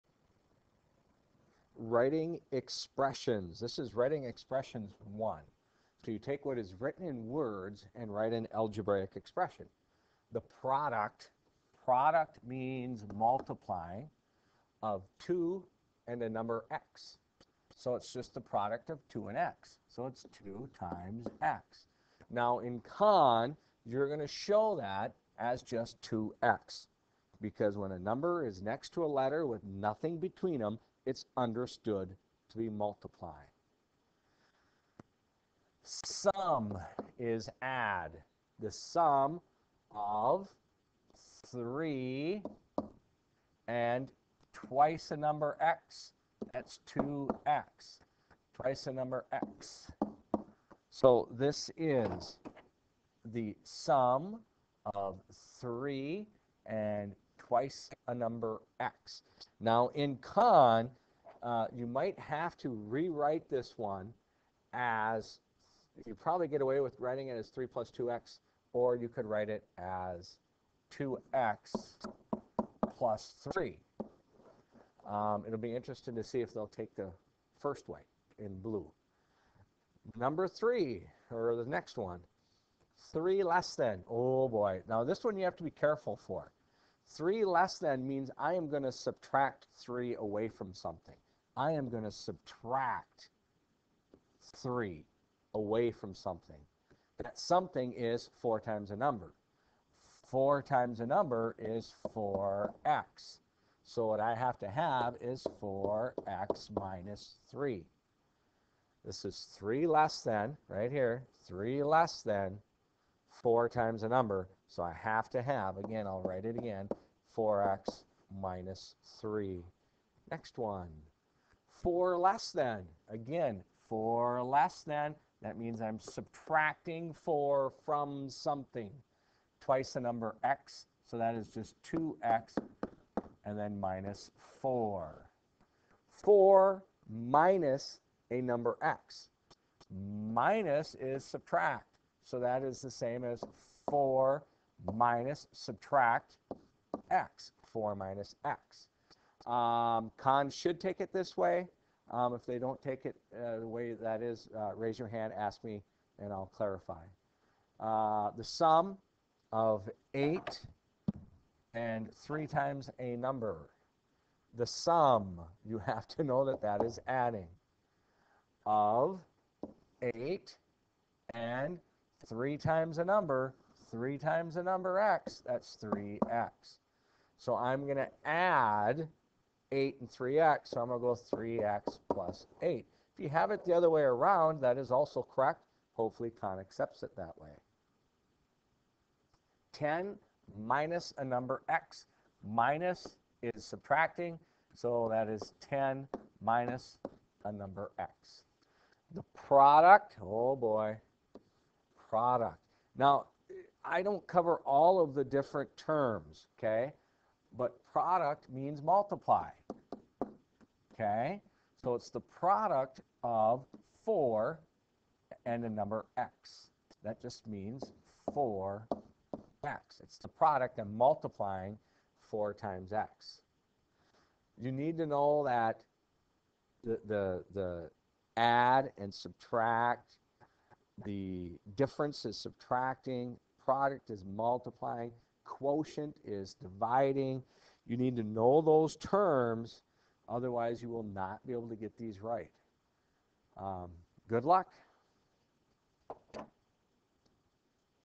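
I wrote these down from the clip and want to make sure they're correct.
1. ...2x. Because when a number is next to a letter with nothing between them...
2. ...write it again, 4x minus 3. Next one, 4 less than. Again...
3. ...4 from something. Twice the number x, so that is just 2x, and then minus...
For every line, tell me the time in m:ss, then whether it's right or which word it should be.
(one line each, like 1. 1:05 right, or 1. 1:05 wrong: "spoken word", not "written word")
1. 0:26 right
2. 1:56 right
3. 2:07 right.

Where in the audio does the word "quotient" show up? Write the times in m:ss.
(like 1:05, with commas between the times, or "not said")
3:55.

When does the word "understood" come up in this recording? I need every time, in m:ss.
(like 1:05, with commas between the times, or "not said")
0:31.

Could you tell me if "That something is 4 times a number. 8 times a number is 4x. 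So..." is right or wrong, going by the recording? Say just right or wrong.
wrong.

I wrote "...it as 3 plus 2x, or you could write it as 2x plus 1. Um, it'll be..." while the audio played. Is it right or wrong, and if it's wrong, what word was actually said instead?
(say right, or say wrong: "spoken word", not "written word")
wrong: "3", not "1".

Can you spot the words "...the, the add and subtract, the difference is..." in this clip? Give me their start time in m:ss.
3:47.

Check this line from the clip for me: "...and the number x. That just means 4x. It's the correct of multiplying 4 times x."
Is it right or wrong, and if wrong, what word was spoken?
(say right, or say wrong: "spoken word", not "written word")
wrong: "product", not "correct".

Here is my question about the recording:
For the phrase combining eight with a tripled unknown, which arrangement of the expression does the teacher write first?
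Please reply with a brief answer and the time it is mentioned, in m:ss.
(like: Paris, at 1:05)
3x plus 8, at 3:01.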